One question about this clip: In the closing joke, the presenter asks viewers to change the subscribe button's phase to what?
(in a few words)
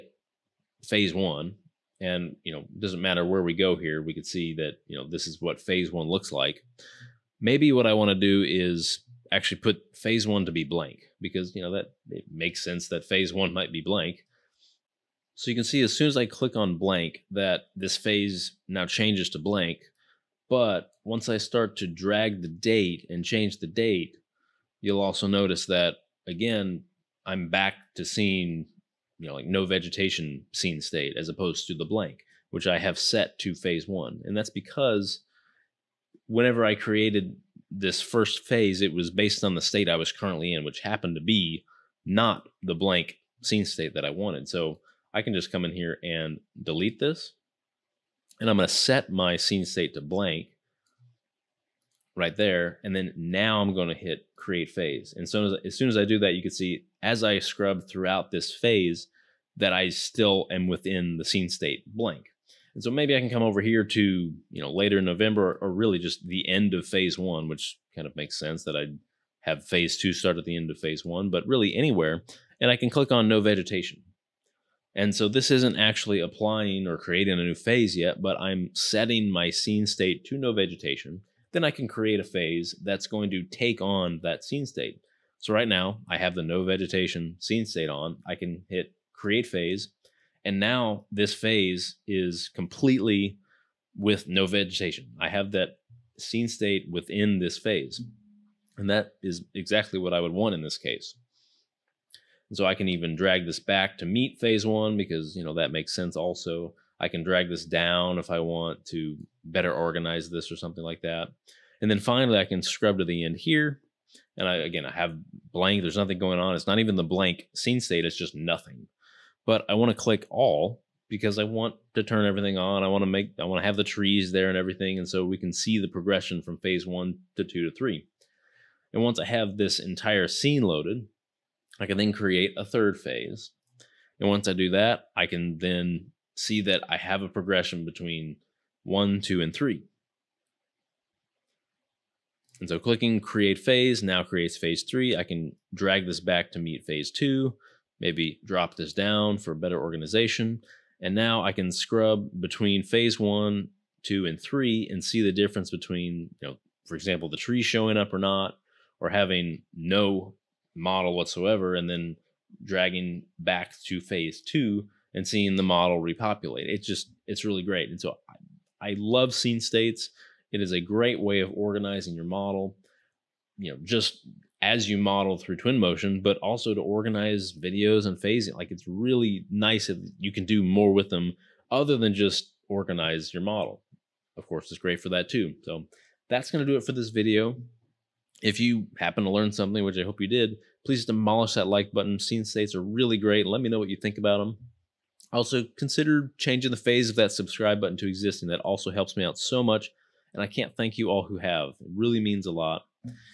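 Existing.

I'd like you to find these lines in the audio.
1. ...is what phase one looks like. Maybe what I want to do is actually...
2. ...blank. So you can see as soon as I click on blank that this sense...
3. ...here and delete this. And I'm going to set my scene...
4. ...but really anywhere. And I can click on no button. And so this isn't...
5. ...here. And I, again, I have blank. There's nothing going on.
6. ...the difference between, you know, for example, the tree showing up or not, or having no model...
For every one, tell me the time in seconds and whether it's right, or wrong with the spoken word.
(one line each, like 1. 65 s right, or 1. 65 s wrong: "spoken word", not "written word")
1. 5 s right
2. 13 s wrong: "phase", not "sense"
3. 45 s right
4. 71 s wrong: "vegetation", not "button"
5. 113 s right
6. 155 s right.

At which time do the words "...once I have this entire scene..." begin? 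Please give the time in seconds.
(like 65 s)
129 s.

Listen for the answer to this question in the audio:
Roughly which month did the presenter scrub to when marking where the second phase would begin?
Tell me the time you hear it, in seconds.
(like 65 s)
65 s.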